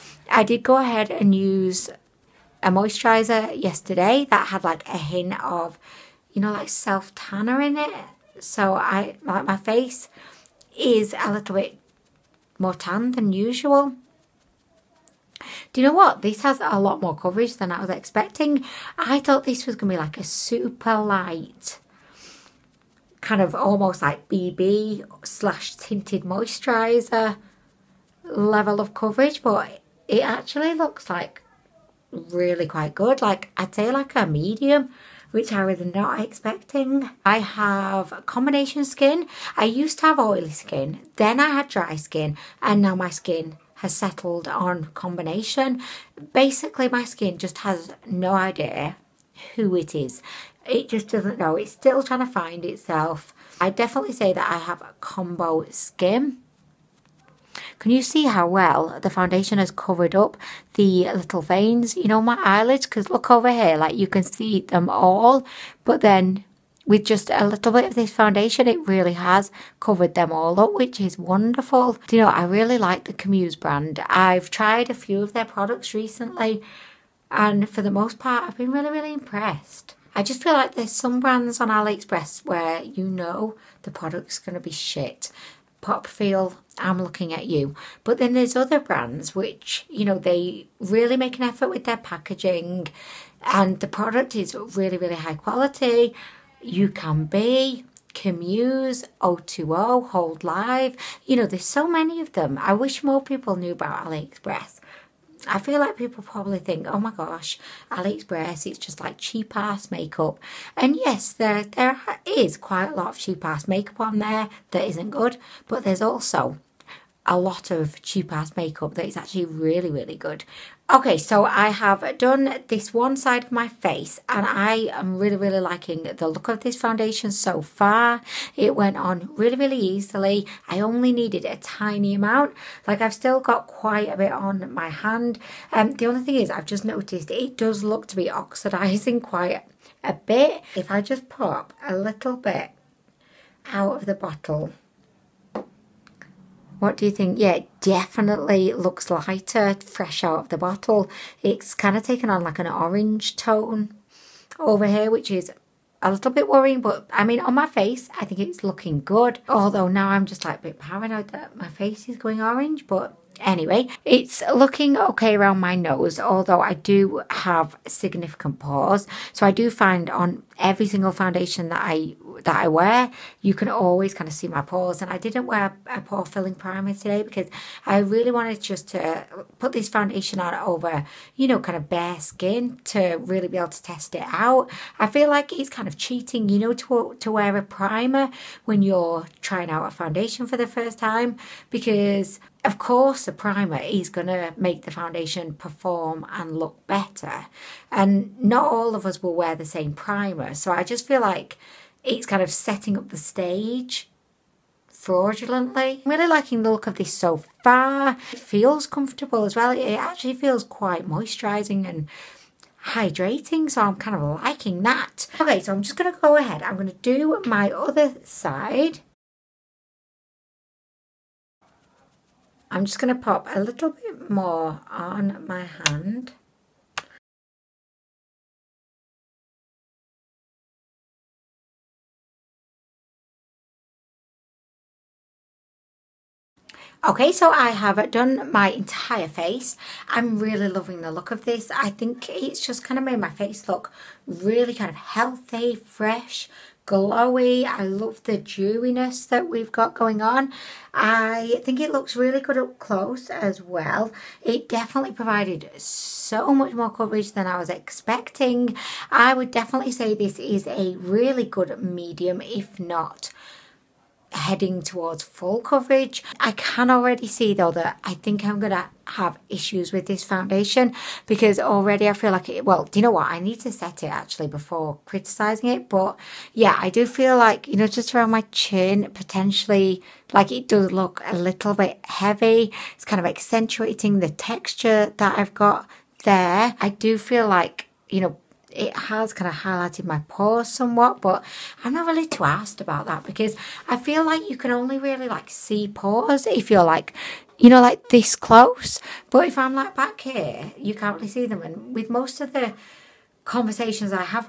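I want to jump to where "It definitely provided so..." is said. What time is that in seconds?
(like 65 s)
254 s.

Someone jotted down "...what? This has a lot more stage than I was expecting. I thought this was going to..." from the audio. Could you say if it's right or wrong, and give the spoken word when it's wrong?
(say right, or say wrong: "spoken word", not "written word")
wrong: "coverage", not "stage".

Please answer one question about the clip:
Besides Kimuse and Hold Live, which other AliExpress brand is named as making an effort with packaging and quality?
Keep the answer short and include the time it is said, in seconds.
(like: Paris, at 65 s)
O2O, at 99 s.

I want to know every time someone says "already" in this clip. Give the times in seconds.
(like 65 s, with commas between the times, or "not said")
266 s, 271 s.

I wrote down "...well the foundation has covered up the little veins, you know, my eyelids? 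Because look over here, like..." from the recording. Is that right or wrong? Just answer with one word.
right.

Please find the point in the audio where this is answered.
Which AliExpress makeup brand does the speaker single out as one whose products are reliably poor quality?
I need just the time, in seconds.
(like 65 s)
85 s.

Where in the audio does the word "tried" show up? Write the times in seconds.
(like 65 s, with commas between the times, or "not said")
74 s.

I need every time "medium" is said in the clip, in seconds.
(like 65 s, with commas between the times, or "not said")
34 s, 261 s.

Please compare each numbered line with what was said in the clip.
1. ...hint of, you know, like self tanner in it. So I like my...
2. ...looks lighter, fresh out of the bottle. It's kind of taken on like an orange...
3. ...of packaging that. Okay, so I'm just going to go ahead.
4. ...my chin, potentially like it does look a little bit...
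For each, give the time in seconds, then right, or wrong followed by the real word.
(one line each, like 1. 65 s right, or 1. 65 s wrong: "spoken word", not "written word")
1. 4 s right
2. 148 s right
3. 214 s wrong: "liking", not "packaging"
4. 278 s right.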